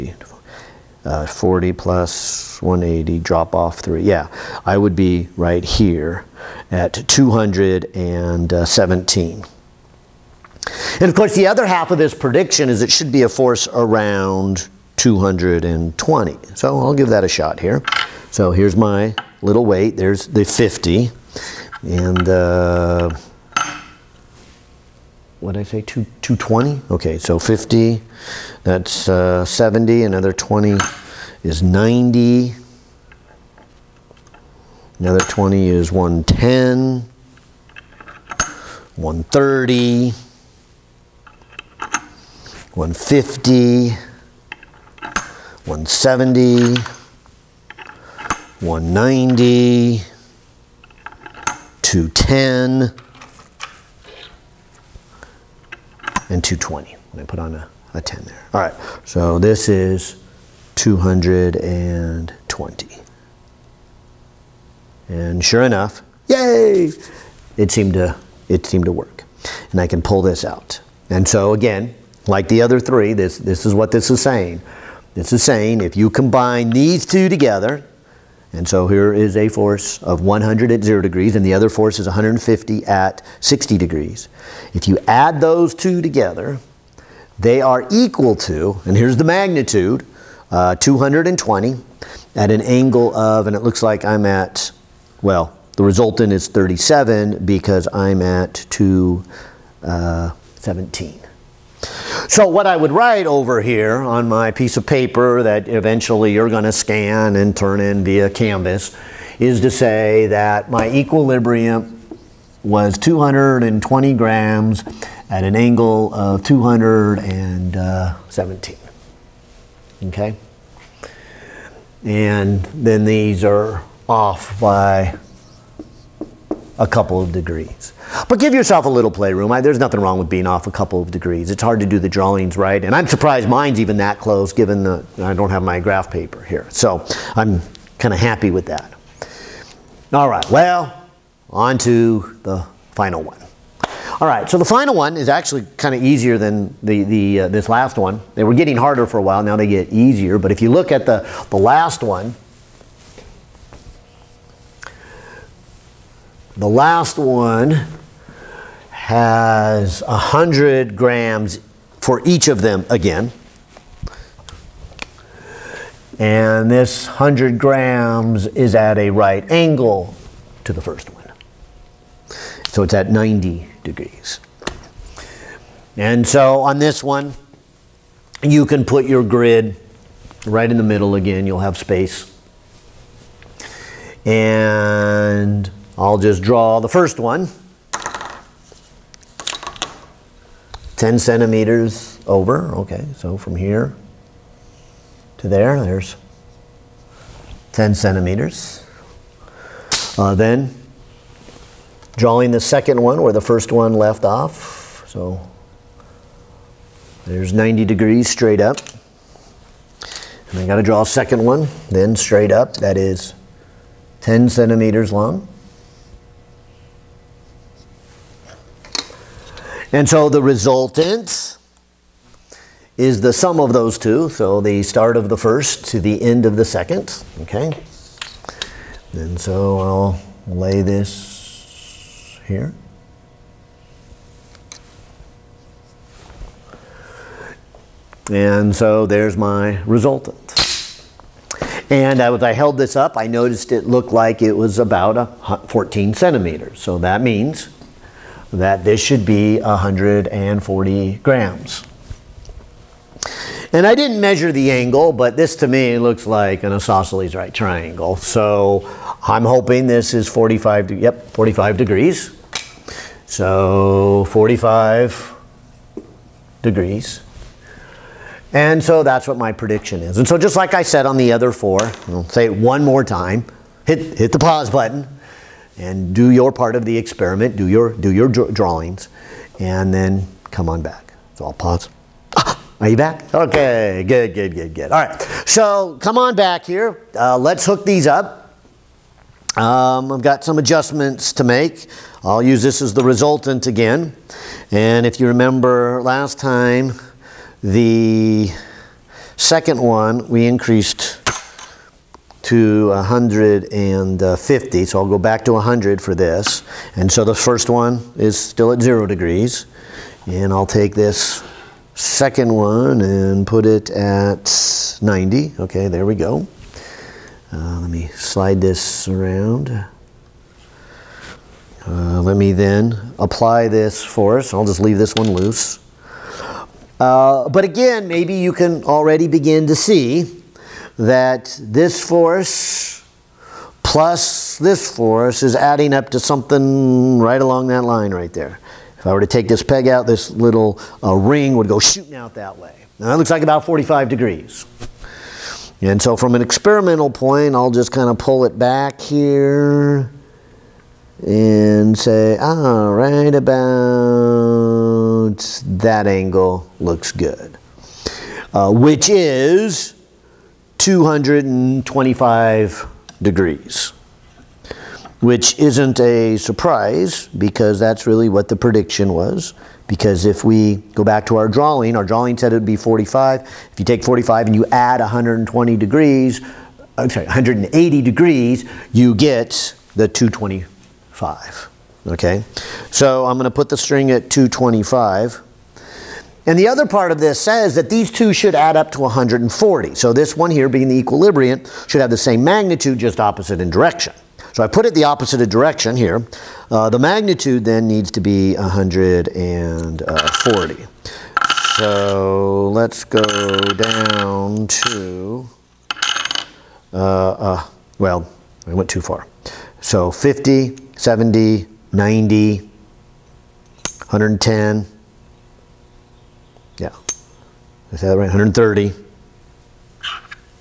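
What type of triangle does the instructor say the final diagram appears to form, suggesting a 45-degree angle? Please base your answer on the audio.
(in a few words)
isosceles right triangle.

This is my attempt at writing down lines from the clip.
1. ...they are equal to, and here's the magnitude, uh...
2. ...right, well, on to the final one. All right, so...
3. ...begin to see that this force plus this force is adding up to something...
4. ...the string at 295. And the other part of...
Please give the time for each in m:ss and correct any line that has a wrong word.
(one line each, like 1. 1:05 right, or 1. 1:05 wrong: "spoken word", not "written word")
1. 1:27 right
2. 2:20 right
3. 5:29 right
4. 6:23 wrong: "225", not "295".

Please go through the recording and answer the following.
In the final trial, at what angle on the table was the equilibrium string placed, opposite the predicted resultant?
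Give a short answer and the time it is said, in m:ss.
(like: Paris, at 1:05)
225 degrees, at 6:00.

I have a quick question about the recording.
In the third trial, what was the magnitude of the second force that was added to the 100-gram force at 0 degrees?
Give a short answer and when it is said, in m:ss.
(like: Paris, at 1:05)
150, at 1:22.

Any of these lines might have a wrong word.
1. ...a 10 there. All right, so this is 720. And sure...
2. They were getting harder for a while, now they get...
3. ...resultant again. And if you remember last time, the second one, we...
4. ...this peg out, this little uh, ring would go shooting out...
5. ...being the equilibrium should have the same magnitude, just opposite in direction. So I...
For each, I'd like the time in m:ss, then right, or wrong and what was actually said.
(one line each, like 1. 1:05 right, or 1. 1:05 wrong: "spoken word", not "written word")
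1. 0:57 wrong: "220", not "720"
2. 2:28 right
3. 4:53 right
4. 5:39 right
5. 6:30 right.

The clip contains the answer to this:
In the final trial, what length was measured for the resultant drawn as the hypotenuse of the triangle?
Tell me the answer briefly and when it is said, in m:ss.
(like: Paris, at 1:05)
14 centimeters, at 4:05.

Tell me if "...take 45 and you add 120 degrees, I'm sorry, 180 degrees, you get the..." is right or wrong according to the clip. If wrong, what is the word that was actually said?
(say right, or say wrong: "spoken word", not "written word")
right.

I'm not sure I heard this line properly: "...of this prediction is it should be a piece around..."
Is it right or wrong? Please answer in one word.
wrong.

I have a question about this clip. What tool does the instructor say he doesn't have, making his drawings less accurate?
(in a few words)
graph paper.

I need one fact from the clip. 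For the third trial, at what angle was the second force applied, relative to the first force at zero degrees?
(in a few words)
60 degrees.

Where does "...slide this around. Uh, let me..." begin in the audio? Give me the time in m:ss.
5:18.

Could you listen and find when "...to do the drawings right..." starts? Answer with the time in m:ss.
2:11.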